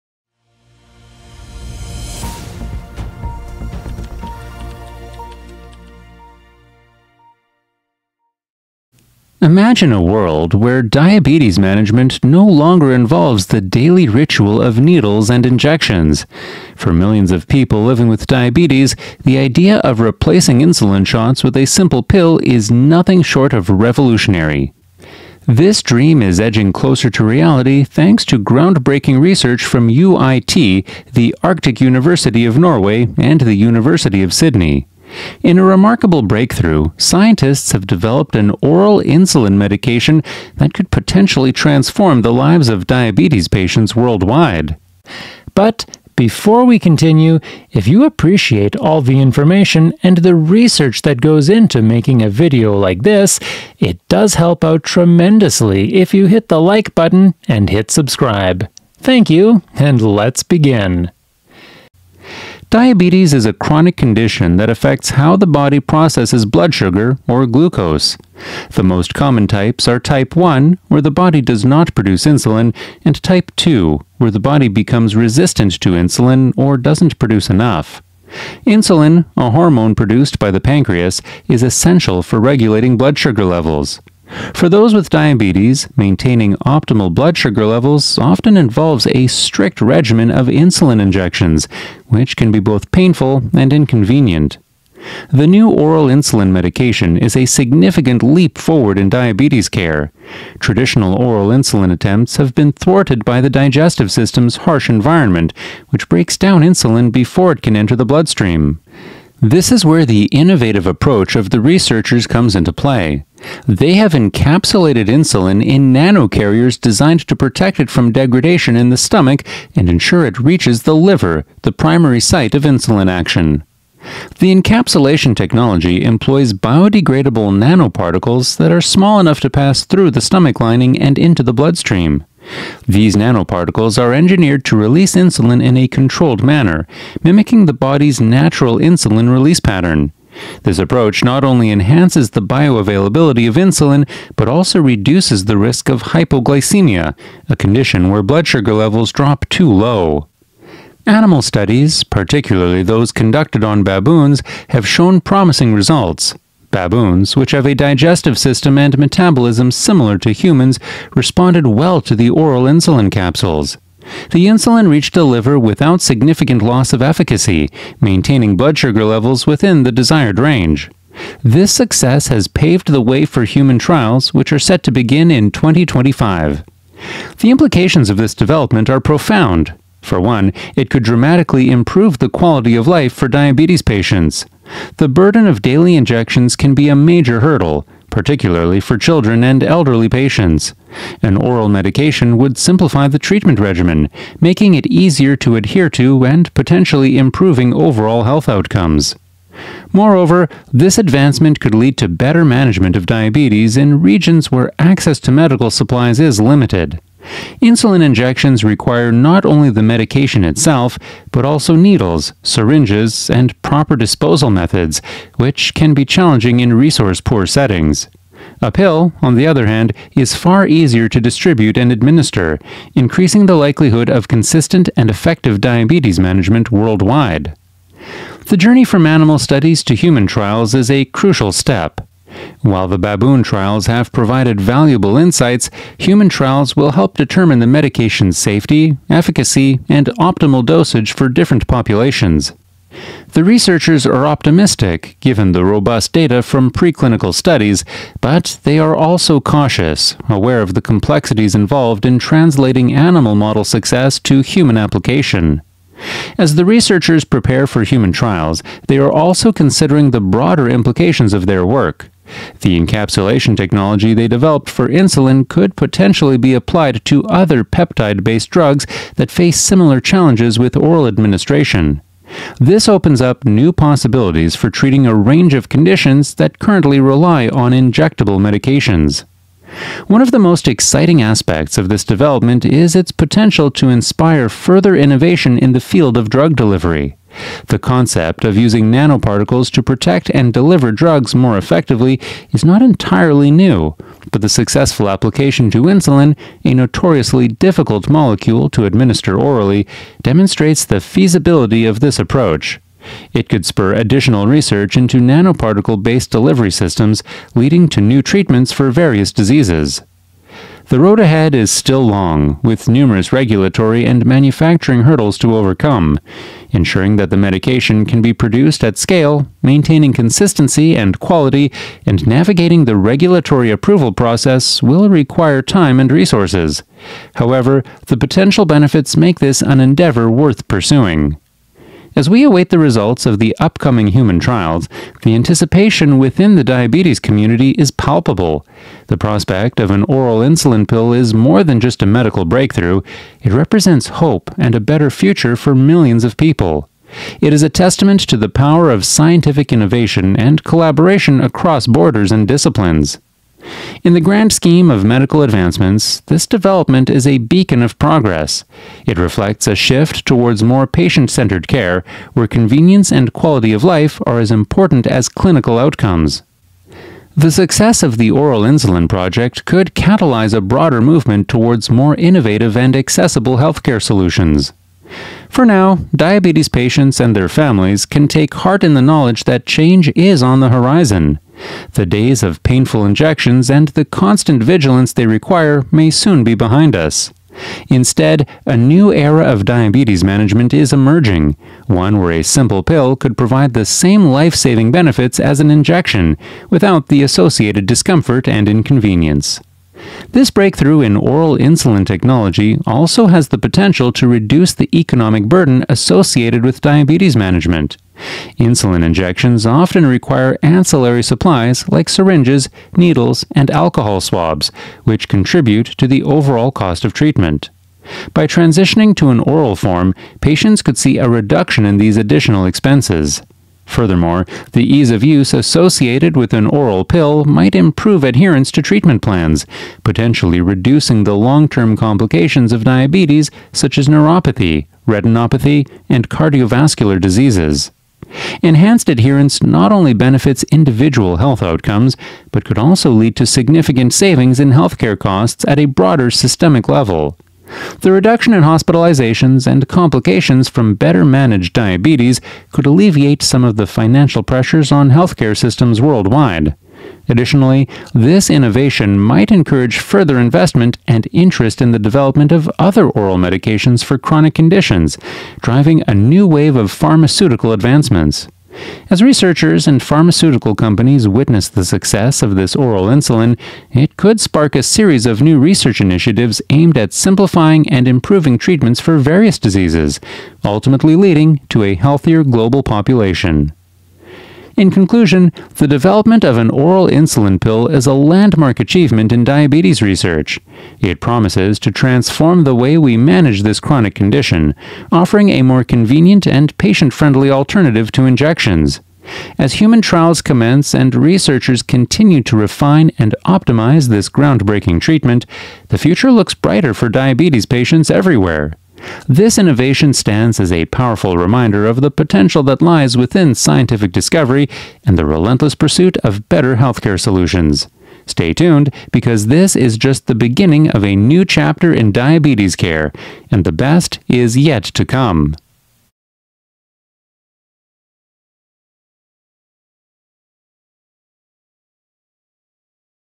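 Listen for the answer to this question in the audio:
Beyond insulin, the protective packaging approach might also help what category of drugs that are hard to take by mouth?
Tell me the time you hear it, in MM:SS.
04:27.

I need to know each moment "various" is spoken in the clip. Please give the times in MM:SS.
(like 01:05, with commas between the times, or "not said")
05:08, 07:59.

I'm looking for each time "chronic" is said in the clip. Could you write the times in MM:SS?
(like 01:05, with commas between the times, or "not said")
01:03, 07:44, 08:13.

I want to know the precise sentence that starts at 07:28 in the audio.
The reduction in hospitalizations and complications from better managed diabetes could alleviate some of the financial pressures on healthcare systems worldwide.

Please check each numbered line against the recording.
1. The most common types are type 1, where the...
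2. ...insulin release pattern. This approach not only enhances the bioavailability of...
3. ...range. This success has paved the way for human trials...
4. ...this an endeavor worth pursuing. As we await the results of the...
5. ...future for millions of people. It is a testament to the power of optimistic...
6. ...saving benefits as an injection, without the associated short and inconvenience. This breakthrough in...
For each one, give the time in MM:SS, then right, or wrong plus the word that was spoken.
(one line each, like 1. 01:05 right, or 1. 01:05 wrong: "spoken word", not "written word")
1. 01:08 right
2. 02:18 right
3. 02:50 right
4. 05:29 right
5. 05:45 wrong: "scientific", not "optimistic"
6. 06:34 wrong: "discomfort", not "short".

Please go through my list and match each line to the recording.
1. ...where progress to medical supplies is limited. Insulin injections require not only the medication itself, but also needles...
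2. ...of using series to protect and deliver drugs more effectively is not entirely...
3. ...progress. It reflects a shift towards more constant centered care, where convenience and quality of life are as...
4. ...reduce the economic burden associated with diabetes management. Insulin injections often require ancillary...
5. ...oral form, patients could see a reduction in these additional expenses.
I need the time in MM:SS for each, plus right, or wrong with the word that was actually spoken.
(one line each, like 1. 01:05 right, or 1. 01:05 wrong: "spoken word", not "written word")
1. 03:24 wrong: "access", not "progress"
2. 04:48 wrong: "nanoparticles", not "series"
3. 05:57 wrong: "patient", not "constant"
4. 06:44 right
5. 06:59 right.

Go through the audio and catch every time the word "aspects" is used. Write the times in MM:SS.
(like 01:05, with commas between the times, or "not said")
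04:41.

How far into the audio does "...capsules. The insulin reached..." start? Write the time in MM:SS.
02:43.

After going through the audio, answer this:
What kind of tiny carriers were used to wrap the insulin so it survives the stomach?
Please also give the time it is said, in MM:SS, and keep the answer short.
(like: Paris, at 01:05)
nanocarriers, at 01:55.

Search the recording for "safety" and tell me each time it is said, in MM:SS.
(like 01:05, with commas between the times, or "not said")
03:58.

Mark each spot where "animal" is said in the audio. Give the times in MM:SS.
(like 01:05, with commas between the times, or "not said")
02:31, 03:49, 04:12.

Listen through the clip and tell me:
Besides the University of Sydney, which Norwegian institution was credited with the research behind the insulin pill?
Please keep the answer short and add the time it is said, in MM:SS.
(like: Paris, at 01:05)
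UIT, the Arctic University of Norway, at 00:29.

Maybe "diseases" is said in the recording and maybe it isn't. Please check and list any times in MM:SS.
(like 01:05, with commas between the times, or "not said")
05:09, 07:17, 07:59.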